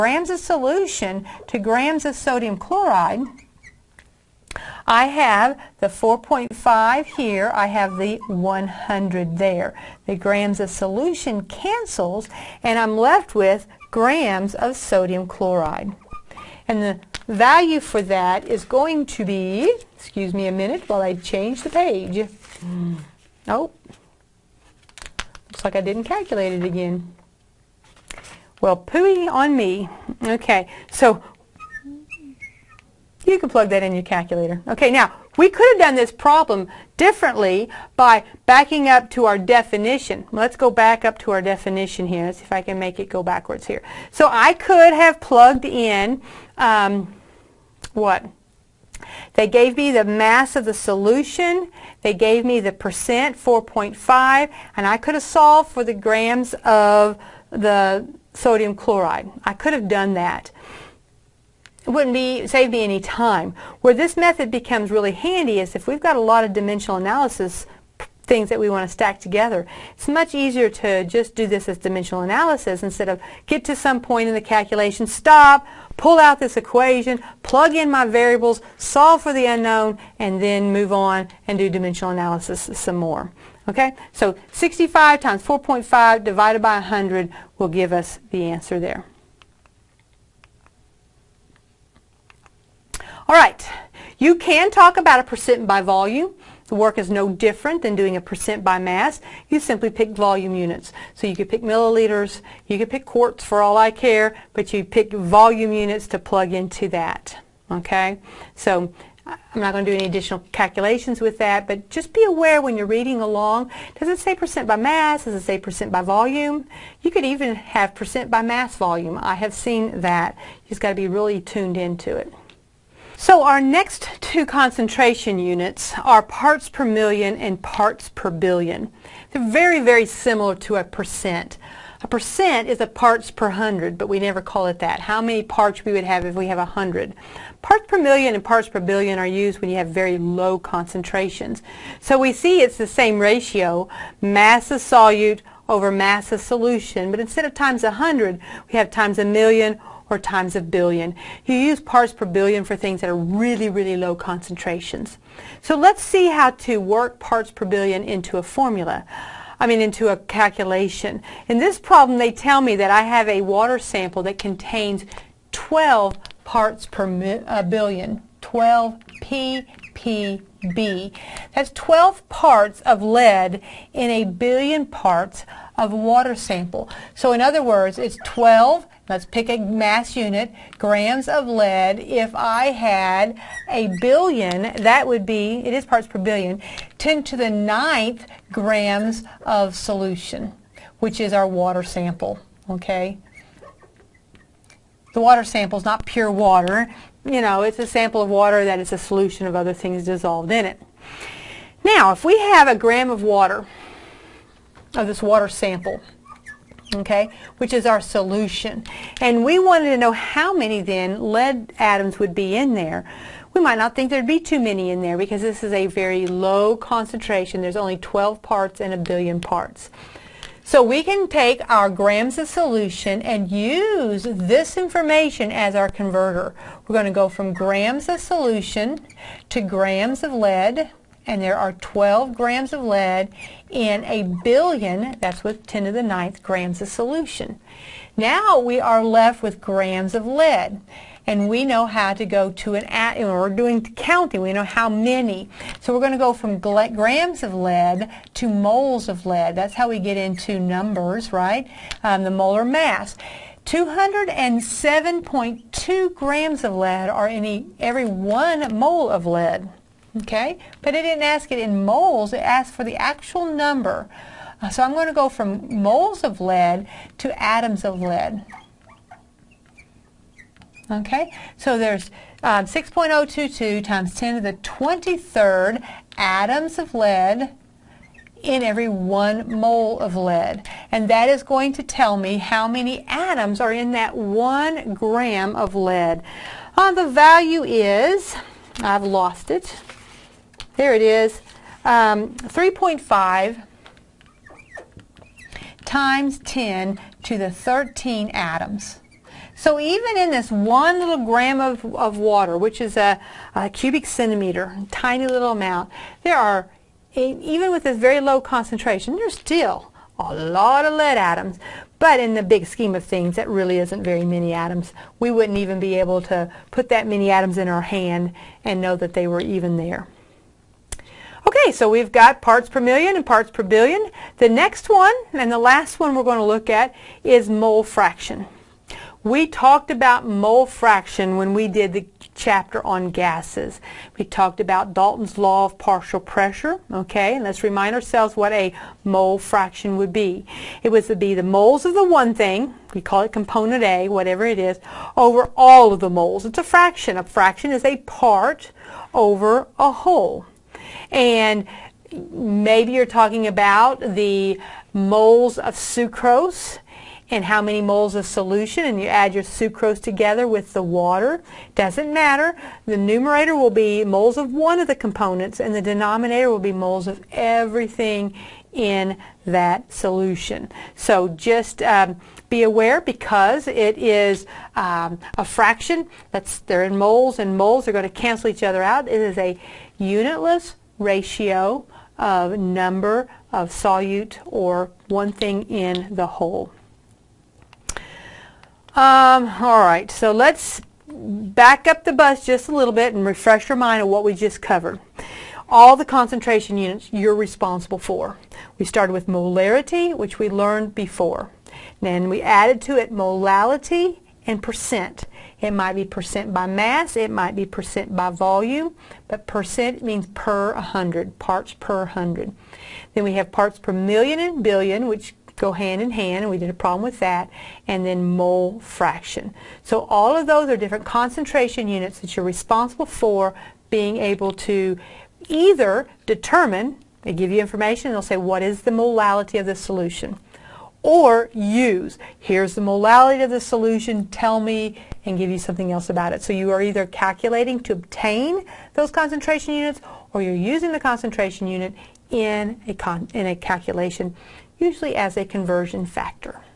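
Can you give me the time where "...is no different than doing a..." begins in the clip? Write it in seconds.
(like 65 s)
96 s.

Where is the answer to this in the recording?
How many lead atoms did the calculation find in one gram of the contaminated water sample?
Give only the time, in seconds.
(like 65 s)
292 s.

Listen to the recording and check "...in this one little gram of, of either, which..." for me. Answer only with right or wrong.
wrong.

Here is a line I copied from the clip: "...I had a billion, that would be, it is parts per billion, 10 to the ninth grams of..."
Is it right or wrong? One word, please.
right.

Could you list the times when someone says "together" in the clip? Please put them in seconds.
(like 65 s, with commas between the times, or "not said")
69 s, 360 s.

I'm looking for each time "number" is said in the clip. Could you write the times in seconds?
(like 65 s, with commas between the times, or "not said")
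250 s, 263 s, 382 s.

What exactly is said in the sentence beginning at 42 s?
Let's see if I can make it go backwards here.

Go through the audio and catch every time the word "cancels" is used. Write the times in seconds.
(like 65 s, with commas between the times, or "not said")
11 s, 378 s.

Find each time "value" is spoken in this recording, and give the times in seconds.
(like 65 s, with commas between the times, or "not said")
17 s, 287 s.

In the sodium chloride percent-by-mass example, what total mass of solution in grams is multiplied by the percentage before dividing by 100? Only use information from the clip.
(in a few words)
65.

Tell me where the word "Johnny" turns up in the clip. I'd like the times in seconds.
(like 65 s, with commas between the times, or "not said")
not said.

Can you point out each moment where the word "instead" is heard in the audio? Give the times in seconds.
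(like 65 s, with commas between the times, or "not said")
72 s, 147 s.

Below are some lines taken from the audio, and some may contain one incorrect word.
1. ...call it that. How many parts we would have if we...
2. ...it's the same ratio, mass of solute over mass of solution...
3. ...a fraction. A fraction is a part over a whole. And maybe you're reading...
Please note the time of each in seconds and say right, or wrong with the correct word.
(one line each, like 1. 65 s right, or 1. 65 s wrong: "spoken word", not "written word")
1. 134 s right
2. 142 s right
3. 346 s wrong: "talking", not "reading".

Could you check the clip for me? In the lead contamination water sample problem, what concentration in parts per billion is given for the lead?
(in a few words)
12 ppb.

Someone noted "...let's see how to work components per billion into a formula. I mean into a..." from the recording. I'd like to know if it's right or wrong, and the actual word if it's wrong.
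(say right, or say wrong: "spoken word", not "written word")
wrong: "parts", not "components".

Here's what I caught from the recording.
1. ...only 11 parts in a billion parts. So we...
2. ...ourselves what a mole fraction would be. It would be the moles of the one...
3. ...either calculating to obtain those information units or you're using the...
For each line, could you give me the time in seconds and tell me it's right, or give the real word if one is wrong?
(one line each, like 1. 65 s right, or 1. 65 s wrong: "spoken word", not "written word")
1. 217 s wrong: "12", not "11"
2. 337 s right
3. 436 s wrong: "concentration", not "information".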